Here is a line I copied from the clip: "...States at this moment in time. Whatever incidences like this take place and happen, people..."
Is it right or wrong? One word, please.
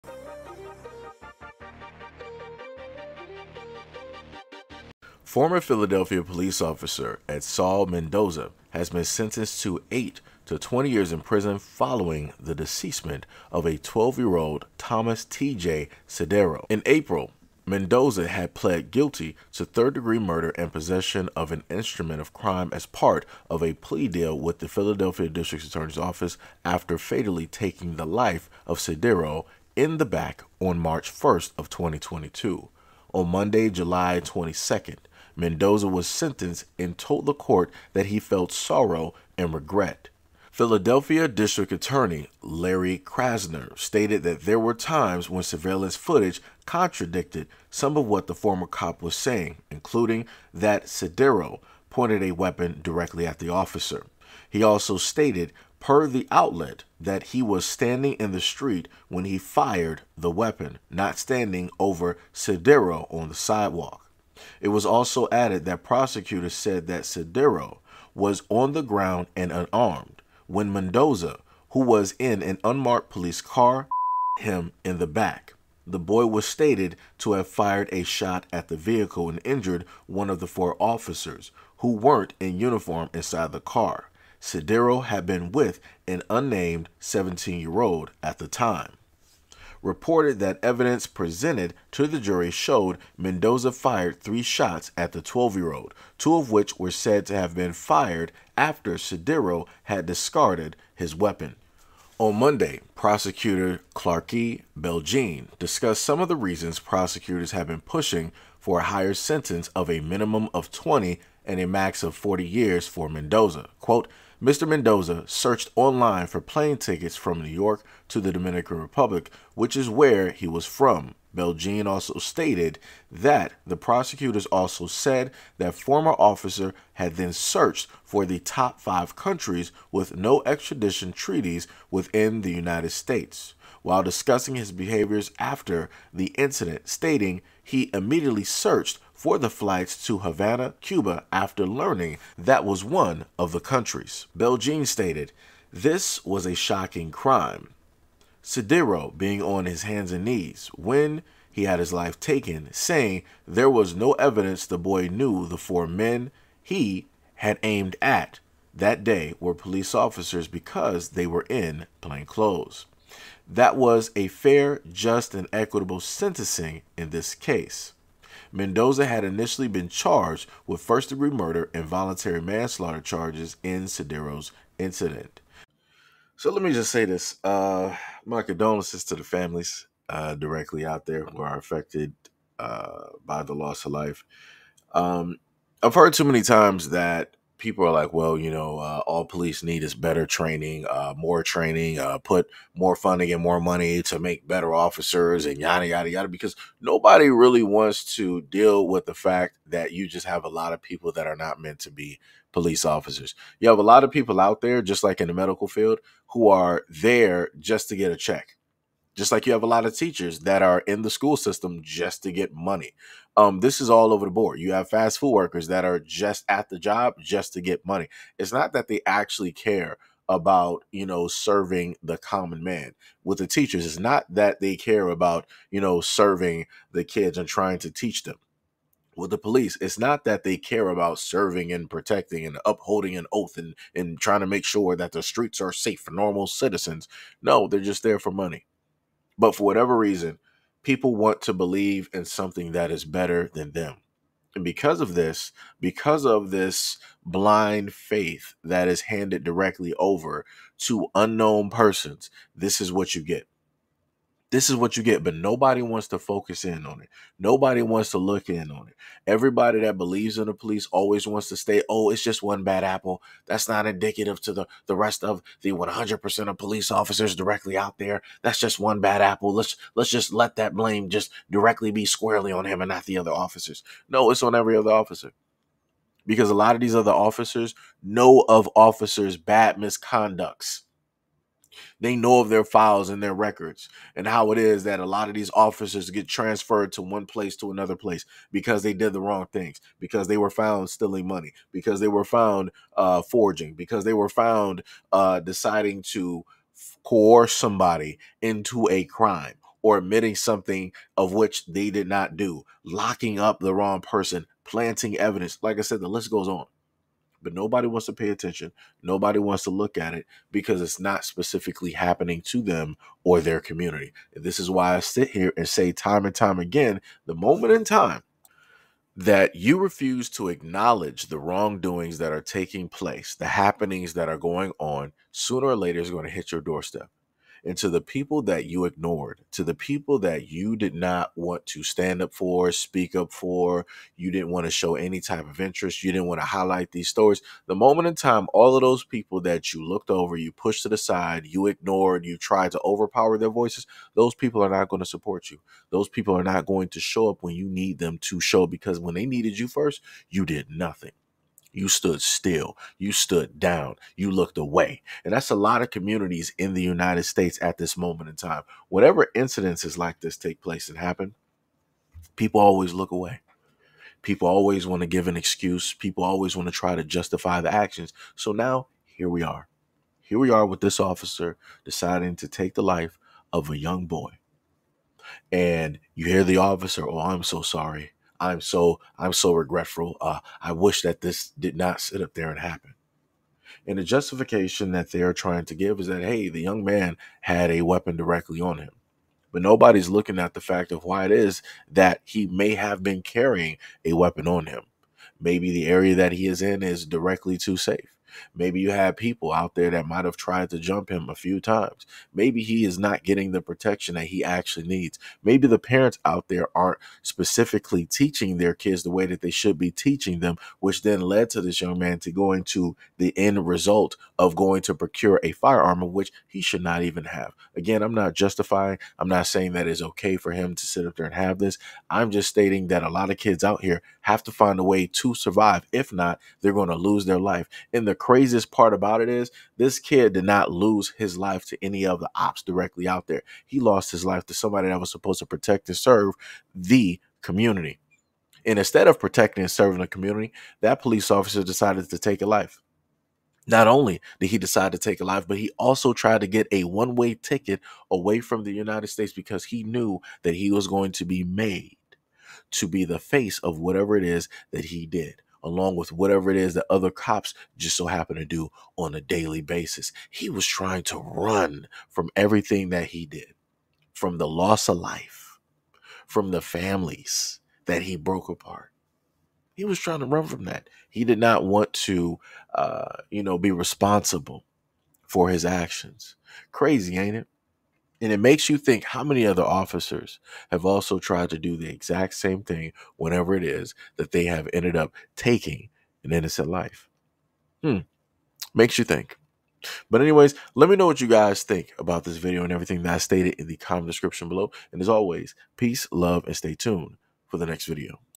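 right.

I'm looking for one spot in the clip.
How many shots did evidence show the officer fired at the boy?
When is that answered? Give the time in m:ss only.
1:34.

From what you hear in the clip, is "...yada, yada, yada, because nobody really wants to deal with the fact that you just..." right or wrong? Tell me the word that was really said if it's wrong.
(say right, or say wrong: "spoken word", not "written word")
right.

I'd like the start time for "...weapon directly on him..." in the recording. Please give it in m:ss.
6:27.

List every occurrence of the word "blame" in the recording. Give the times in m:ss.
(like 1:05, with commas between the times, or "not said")
4:30.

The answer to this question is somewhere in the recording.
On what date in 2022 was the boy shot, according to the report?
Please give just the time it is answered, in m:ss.
0:30.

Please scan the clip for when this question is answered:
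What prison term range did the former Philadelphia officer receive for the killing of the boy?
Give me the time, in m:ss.
0:09.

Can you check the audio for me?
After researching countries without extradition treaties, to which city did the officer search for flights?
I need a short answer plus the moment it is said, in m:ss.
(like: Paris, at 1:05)
Havana, Cuba, at 2:20.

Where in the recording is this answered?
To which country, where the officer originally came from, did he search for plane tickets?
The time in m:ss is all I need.
1:58.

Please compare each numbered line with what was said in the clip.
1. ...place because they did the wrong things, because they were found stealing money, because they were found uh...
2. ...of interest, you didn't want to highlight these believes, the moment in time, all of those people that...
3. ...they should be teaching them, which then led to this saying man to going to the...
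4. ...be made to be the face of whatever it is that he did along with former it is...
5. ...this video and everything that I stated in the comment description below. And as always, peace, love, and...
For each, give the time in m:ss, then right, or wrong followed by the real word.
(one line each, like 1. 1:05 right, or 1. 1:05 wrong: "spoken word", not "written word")
1. 4:47 right
2. 5:35 wrong: "stories", not "believes"
3. 6:49 wrong: "young", not "saying"
4. 7:31 wrong: "whatever", not "former"
5. 8:12 right.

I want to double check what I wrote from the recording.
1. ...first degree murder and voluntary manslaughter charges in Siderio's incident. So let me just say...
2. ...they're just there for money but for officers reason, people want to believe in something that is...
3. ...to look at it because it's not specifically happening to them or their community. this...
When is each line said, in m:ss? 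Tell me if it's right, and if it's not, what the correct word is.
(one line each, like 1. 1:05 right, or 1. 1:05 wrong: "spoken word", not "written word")
1. 2:50 right
2. 3:57 wrong: "whatever", not "officers"
3. 5:09 right.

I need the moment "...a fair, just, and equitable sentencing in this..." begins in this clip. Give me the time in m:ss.
2:44.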